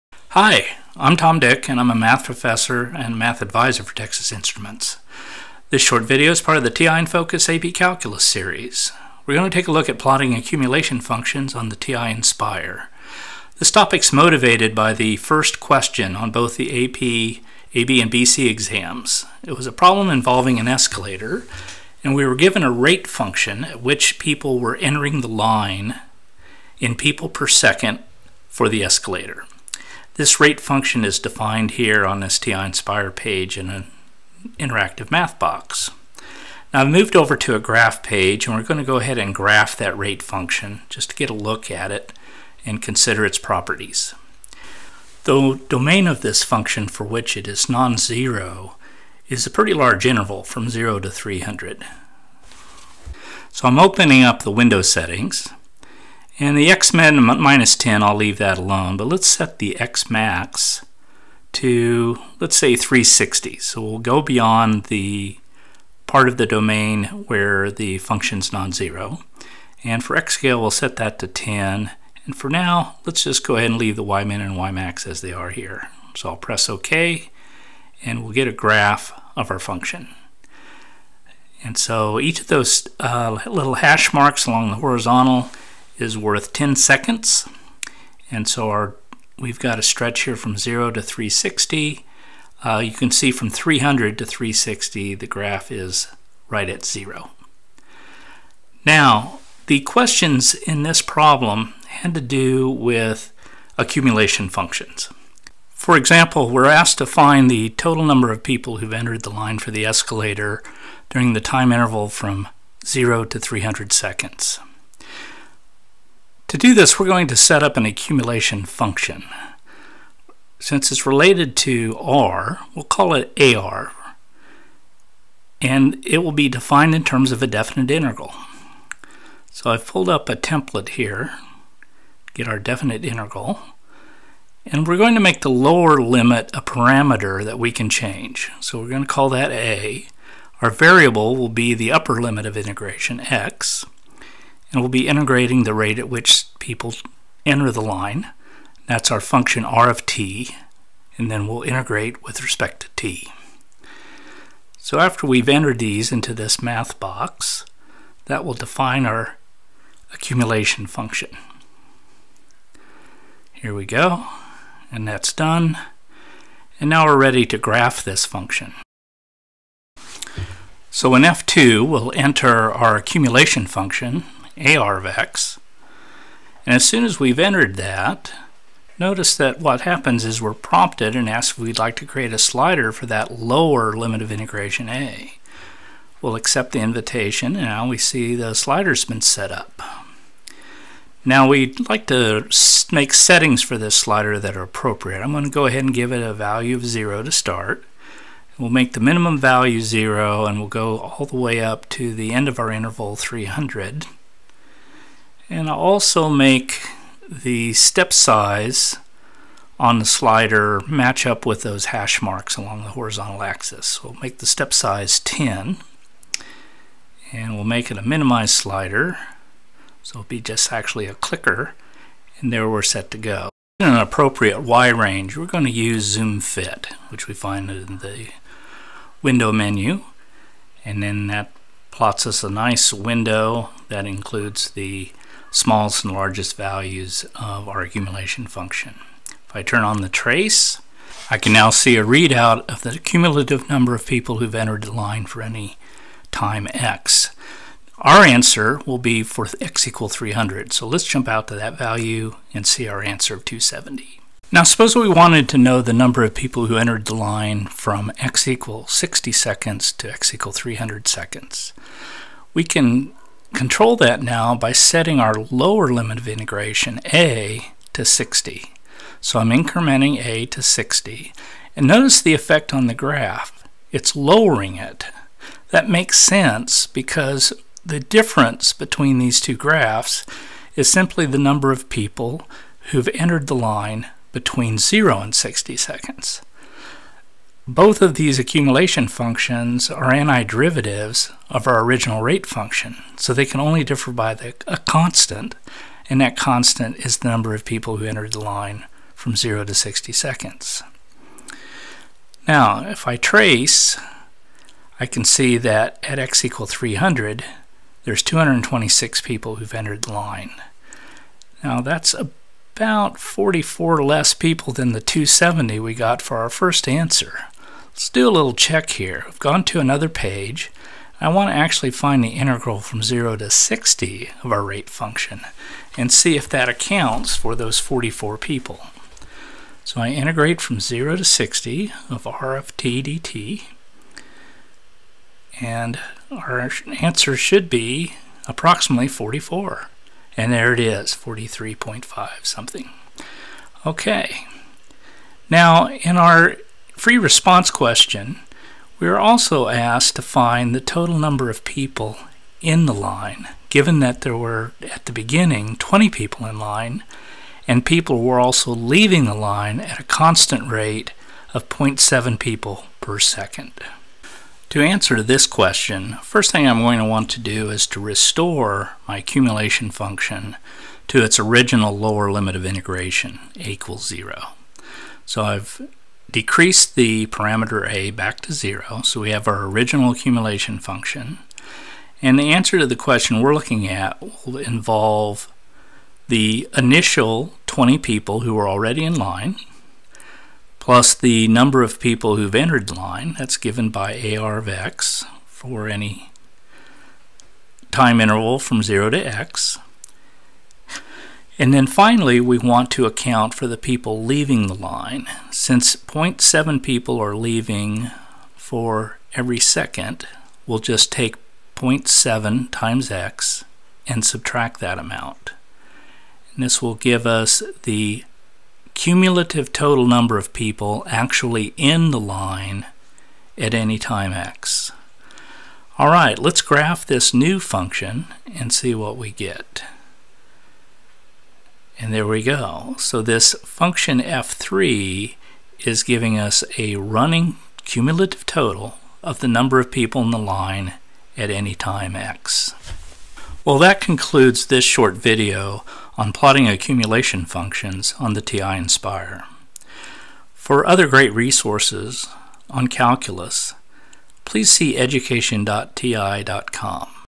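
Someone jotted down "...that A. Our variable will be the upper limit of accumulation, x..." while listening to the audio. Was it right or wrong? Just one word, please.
wrong.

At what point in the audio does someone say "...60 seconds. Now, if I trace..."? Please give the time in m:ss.
4:59.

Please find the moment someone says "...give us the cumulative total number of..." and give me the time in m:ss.
6:56.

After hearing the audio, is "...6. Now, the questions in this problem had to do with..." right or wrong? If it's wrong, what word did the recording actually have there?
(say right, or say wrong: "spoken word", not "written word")
wrong: "0", not "6".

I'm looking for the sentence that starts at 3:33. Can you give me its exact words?
So we'll make the step size 10 and we'll make it a minimized slider.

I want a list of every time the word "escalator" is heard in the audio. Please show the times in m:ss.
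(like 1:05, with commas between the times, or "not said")
0:20, 0:28, 1:49.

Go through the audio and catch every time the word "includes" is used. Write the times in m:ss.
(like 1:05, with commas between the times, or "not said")
3:54.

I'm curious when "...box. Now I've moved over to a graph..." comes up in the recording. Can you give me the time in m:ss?
0:35.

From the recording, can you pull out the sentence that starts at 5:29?
So I integrate from 0 to 60 of r of t dt, and our answer should be approximately 44.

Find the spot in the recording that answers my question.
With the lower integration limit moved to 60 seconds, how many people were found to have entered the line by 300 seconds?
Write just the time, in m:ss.
5:08.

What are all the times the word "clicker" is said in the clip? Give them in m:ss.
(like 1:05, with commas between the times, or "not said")
3:41.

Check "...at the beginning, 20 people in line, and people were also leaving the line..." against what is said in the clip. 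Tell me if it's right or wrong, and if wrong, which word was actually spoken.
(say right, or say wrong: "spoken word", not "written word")
right.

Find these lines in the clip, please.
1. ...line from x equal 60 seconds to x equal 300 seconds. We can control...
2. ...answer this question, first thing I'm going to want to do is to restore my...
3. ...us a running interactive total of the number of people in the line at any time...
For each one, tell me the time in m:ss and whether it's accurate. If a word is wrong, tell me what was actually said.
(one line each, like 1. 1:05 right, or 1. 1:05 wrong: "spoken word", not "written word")
1. 4:17 right
2. 6:04 right
3. 7:16 wrong: "cumulative", not "interactive".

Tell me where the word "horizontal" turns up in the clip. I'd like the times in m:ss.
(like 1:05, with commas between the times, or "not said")
1:24, 3:32.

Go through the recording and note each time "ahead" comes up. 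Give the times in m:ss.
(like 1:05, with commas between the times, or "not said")
0:38, 1:13, 3:15.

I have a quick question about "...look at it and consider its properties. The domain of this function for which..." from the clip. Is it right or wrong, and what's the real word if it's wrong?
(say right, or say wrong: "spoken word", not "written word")
right.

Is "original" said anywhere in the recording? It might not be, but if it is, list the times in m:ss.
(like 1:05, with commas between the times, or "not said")
4:51, 6:11, 6:19.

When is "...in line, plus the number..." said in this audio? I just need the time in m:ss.
6:29.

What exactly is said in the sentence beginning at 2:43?
Here we go, and that's done.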